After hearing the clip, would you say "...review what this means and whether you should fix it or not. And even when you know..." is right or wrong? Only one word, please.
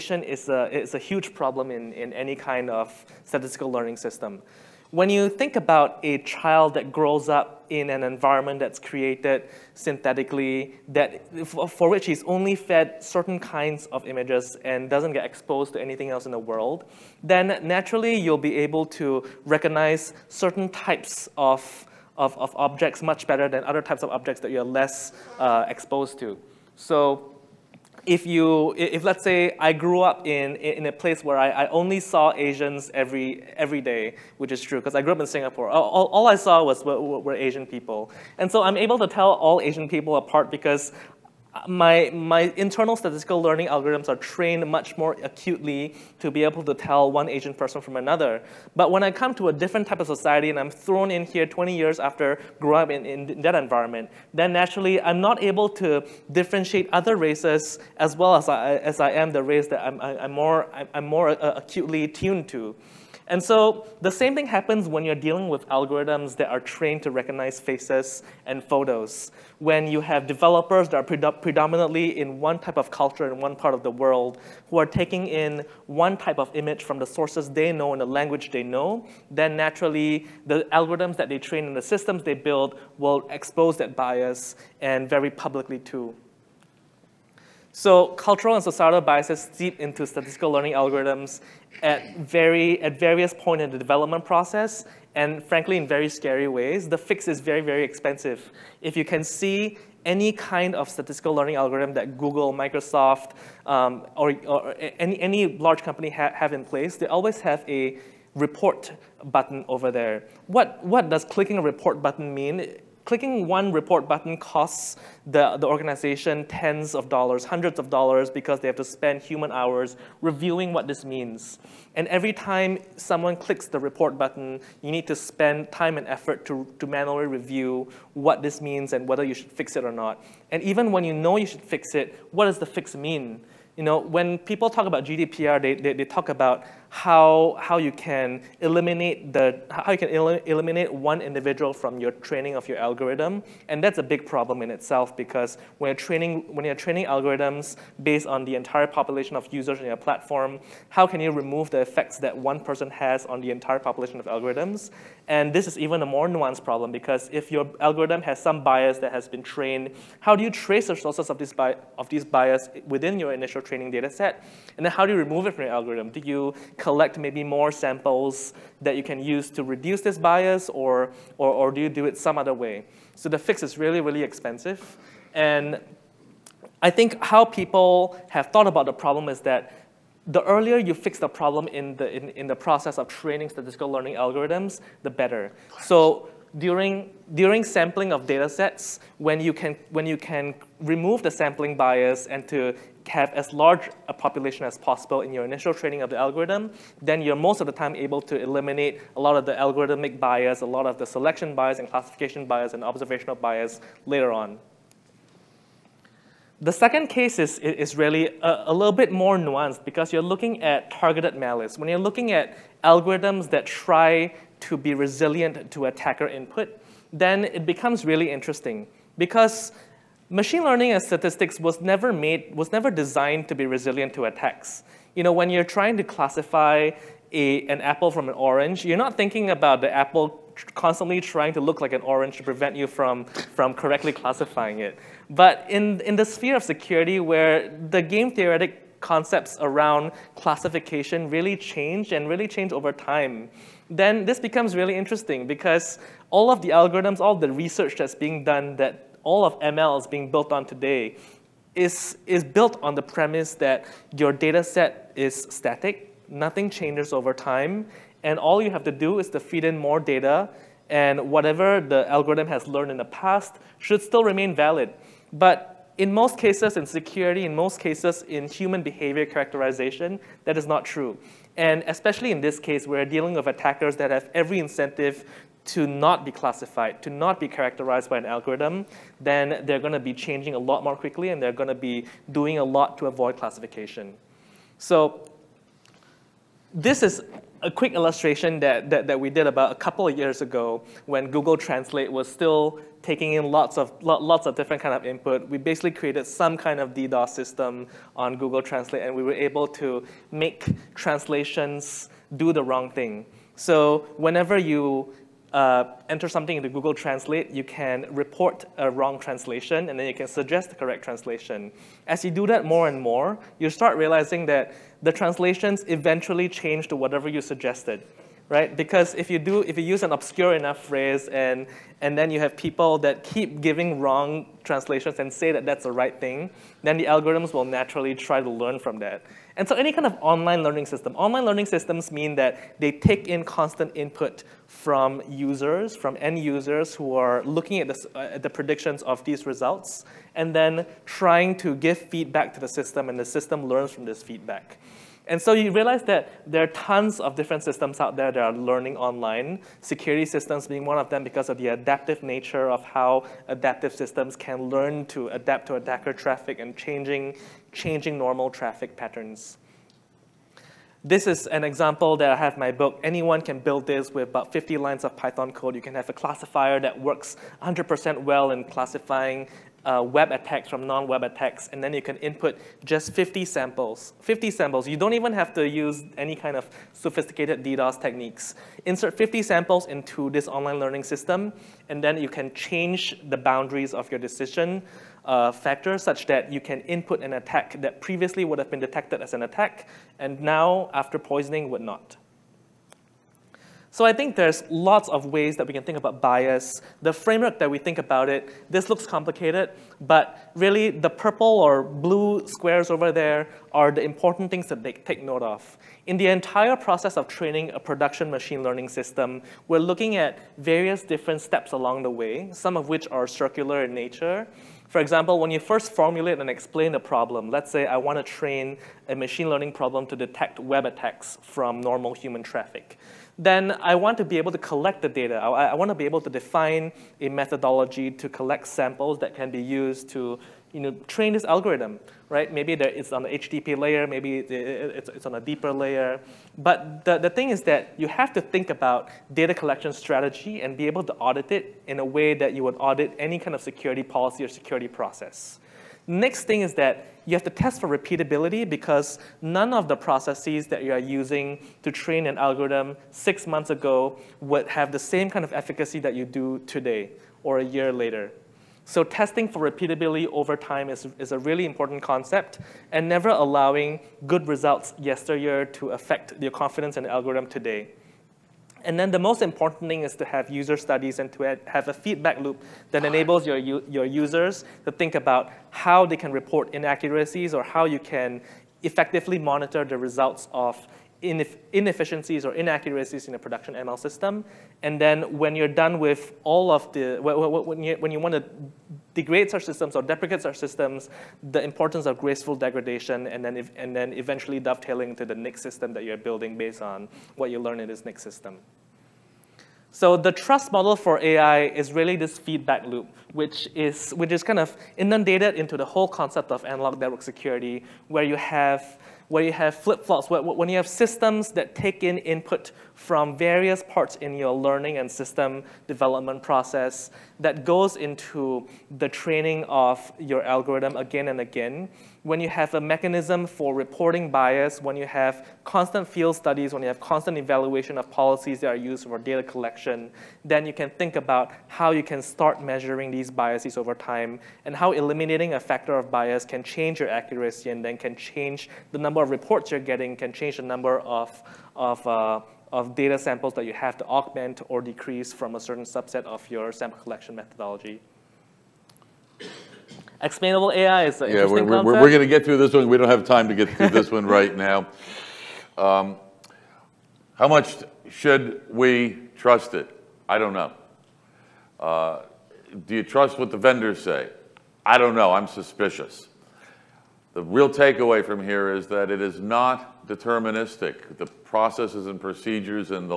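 right.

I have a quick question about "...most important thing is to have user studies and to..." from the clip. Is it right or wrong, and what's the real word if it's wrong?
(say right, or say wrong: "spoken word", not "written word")
right.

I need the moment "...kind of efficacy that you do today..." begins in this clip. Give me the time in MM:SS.
07:35.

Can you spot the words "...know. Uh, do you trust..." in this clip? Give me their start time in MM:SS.
09:20.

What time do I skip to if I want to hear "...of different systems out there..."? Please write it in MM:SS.
05:47.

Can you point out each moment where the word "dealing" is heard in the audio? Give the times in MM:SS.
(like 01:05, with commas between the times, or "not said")
01:05, 04:33.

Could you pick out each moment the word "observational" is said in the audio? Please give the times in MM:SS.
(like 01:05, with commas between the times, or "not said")
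03:22.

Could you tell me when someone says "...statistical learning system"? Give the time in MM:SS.
00:03.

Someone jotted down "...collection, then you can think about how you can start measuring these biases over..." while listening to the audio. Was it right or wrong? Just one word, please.
right.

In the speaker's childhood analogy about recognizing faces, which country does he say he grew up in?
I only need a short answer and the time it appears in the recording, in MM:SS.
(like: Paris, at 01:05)
Singapore, at 00:35.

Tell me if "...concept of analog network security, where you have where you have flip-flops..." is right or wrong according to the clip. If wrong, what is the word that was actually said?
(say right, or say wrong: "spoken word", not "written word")
right.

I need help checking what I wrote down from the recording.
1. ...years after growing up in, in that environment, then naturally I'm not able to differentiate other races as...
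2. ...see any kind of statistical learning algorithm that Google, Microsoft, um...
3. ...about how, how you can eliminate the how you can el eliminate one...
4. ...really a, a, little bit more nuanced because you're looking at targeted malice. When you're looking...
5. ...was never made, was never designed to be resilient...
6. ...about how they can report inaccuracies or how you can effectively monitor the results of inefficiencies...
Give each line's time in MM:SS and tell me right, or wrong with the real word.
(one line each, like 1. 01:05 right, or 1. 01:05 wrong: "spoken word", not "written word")
1. 00:51 right
2. 01:39 right
3. 02:16 right
4. 03:27 right
5. 03:41 right
6. 07:55 right.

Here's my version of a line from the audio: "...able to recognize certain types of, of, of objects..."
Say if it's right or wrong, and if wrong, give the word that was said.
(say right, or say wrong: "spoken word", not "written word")
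right.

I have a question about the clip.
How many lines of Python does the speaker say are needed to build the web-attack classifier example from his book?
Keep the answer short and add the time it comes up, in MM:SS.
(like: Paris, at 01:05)
50, at 06:04.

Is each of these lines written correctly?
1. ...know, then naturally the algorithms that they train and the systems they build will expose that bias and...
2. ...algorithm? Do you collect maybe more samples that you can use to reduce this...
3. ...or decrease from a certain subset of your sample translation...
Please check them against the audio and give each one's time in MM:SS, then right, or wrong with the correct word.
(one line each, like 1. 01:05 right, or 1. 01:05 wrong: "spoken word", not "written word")
1. 01:18 right
2. 02:45 right
3. 09:04 wrong: "collection", not "translation".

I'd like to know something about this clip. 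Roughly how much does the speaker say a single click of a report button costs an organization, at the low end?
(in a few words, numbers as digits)
tens of dollars.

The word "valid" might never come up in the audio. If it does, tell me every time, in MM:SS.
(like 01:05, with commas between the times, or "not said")
04:24.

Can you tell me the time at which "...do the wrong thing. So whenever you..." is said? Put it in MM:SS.
05:02.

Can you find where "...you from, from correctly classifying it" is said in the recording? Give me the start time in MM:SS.
03:52.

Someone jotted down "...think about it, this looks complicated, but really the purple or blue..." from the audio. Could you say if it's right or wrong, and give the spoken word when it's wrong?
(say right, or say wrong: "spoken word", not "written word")
right.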